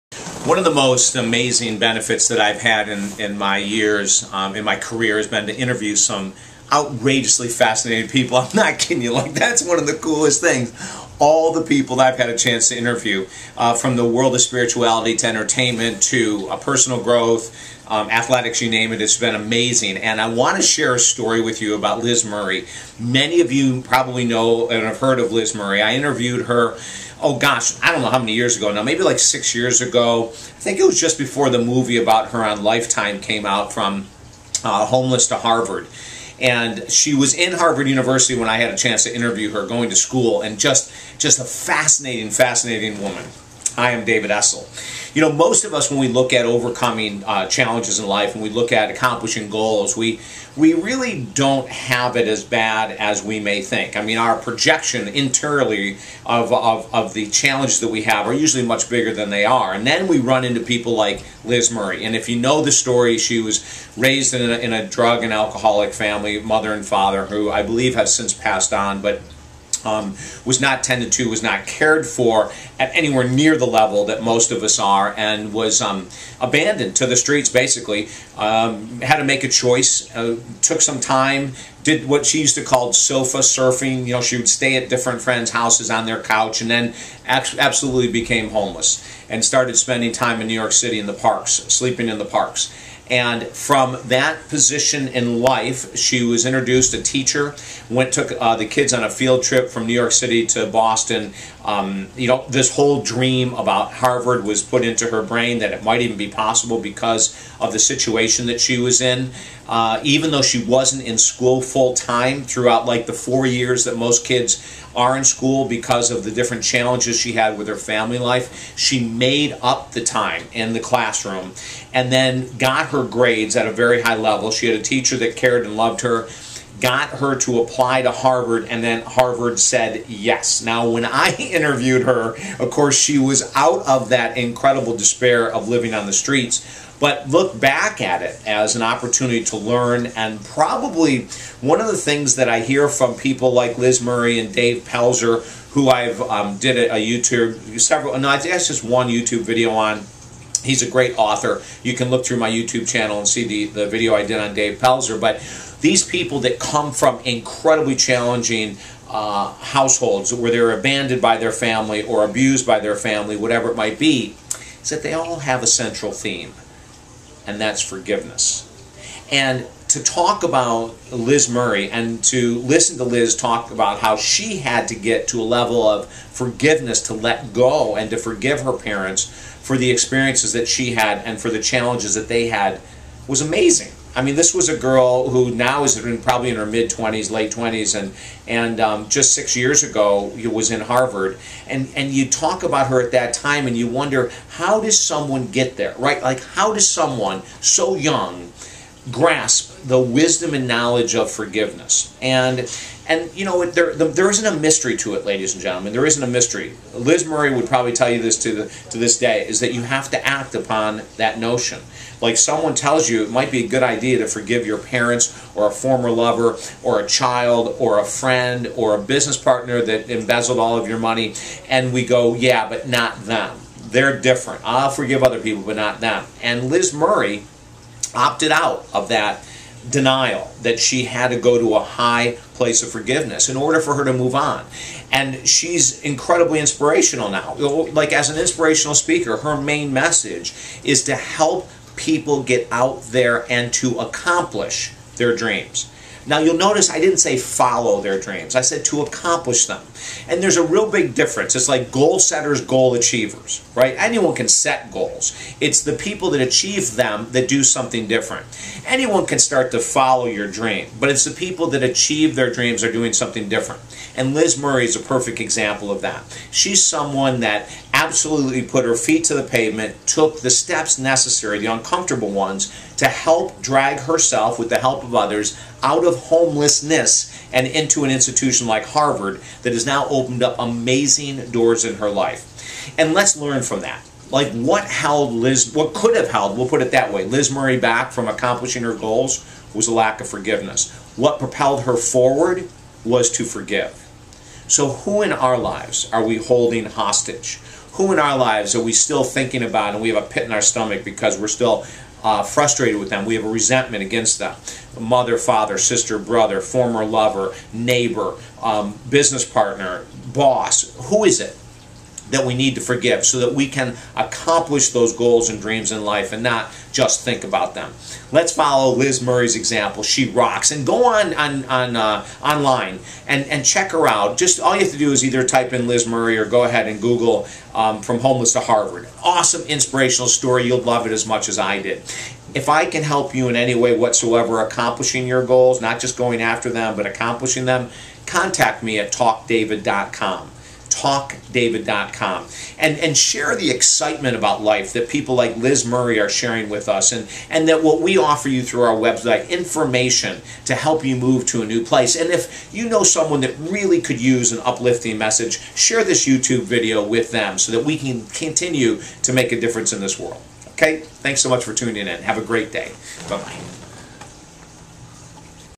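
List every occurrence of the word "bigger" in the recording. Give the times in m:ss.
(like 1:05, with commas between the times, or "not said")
0:58.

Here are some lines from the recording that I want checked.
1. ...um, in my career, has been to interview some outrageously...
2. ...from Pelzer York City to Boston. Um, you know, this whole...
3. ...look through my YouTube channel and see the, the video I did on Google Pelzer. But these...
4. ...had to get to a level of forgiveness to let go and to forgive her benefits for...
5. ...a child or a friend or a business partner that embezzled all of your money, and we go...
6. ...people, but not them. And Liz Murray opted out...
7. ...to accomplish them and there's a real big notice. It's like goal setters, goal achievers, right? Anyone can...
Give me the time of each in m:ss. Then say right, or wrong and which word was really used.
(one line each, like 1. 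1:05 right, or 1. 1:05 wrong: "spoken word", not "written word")
1. 0:04 right
2. 1:39 wrong: "New", not "Pelzer"
3. 2:32 wrong: "Dave", not "Google"
4. 2:54 wrong: "parents", not "benefits"
5. 3:36 right
6. 3:45 right
7. 4:08 wrong: "difference", not "notice".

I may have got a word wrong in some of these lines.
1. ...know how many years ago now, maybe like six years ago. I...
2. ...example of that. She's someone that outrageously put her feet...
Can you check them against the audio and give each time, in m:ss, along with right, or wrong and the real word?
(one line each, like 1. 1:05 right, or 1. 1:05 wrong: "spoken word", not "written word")
1. 0:28 right
2. 4:25 wrong: "absolutely", not "outrageously".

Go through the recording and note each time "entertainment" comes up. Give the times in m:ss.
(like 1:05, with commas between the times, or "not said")
0:15.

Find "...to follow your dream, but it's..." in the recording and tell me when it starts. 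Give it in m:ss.
4:19.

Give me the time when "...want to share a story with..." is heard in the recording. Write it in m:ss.
0:20.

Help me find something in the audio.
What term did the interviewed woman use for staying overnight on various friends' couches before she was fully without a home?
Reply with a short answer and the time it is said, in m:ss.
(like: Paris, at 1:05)
sofa surfing, at 1:22.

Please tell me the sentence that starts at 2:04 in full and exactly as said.
She had a teacher that cared and loved her got her to apply to Harvard, and then Harvard said yes.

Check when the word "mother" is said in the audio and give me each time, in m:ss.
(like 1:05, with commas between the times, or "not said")
1:06, 5:04.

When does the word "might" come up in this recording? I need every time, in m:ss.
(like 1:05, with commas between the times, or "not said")
1:45, 2:43, 3:33.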